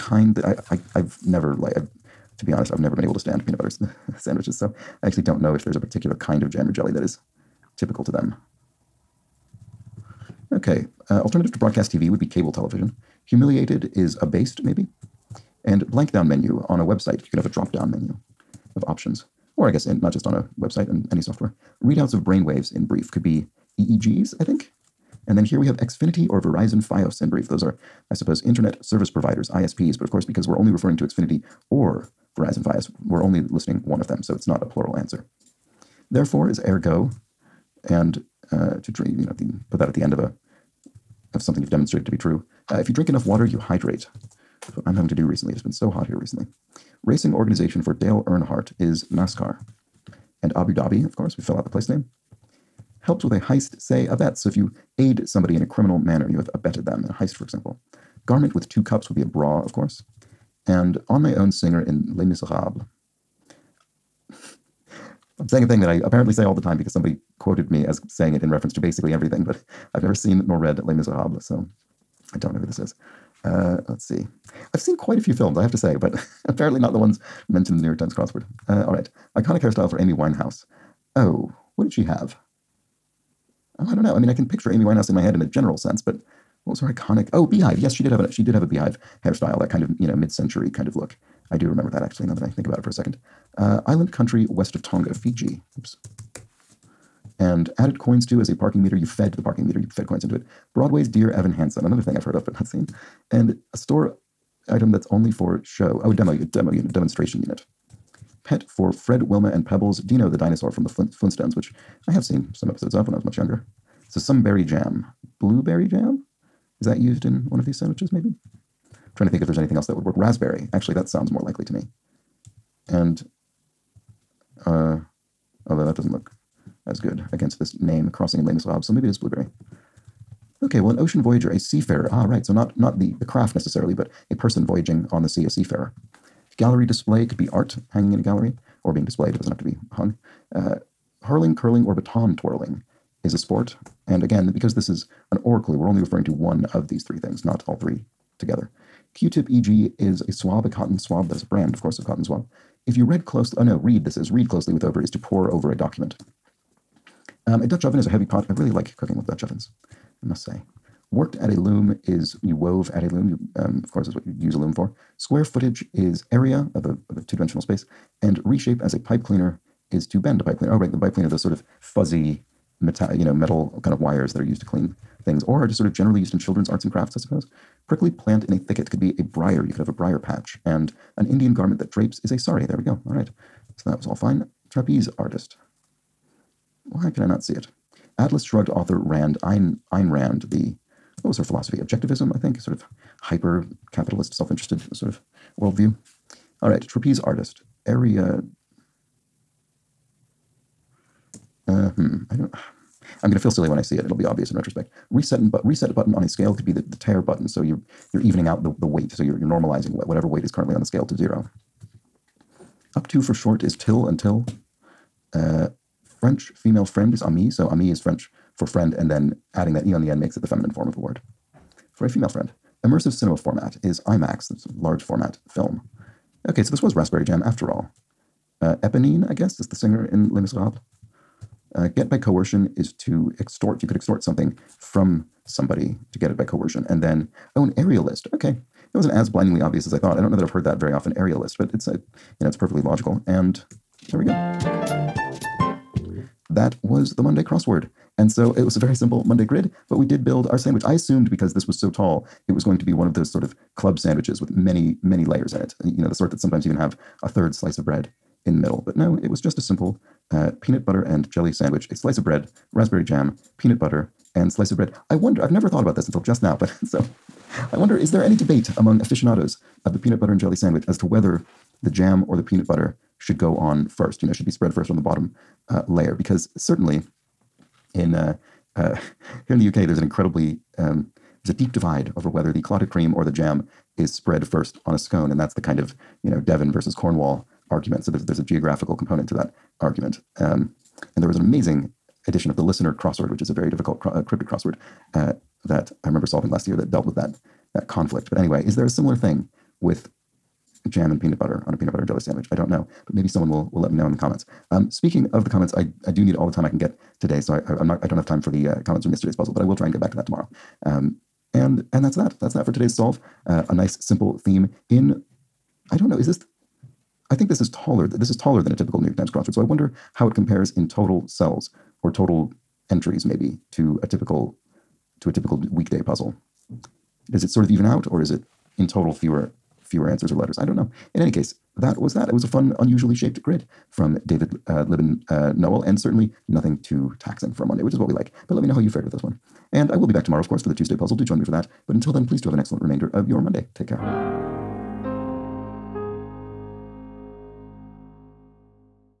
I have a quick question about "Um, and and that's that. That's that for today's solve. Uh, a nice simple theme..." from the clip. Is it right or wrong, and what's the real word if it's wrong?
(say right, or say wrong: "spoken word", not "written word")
right.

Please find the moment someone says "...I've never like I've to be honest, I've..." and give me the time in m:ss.
0:00.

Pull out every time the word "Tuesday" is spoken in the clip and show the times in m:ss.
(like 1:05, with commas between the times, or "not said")
5:40.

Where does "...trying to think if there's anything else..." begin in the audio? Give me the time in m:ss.
1:59.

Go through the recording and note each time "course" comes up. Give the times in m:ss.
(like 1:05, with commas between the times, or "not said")
0:30, 0:51, 0:59, 2:31, 2:43, 5:40.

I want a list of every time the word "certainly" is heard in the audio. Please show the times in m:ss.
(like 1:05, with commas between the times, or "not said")
4:36, 5:35.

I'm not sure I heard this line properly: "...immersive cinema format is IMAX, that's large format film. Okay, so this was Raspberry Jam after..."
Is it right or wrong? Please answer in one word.
right.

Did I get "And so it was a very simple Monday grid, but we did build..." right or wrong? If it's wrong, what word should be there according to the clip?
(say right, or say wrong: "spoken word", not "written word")
right.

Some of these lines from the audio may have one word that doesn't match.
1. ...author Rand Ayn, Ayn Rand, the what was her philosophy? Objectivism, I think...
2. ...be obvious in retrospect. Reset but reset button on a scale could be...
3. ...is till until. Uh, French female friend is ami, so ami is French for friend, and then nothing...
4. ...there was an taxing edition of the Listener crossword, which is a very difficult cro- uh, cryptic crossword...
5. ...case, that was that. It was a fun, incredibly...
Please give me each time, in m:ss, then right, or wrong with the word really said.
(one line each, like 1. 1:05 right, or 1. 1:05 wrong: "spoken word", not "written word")
1. 3:08 right
2. 3:24 right
3. 3:33 wrong: "adding", not "nothing"
4. 4:51 wrong: "amazing", not "taxing"
5. 5:31 wrong: "unusually", not "incredibly".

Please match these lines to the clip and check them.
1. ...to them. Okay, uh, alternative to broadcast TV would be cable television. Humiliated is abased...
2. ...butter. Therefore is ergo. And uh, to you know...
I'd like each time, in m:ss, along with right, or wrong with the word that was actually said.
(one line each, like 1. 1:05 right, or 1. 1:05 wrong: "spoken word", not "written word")
1. 0:08 right
2. 0:34 wrong: "answer", not "butter".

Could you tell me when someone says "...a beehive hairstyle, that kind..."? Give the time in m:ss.
1:28.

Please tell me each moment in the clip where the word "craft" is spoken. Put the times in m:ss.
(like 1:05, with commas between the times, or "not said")
2:13, 2:56.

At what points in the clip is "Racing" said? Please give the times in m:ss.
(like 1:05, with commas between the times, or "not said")
0:47.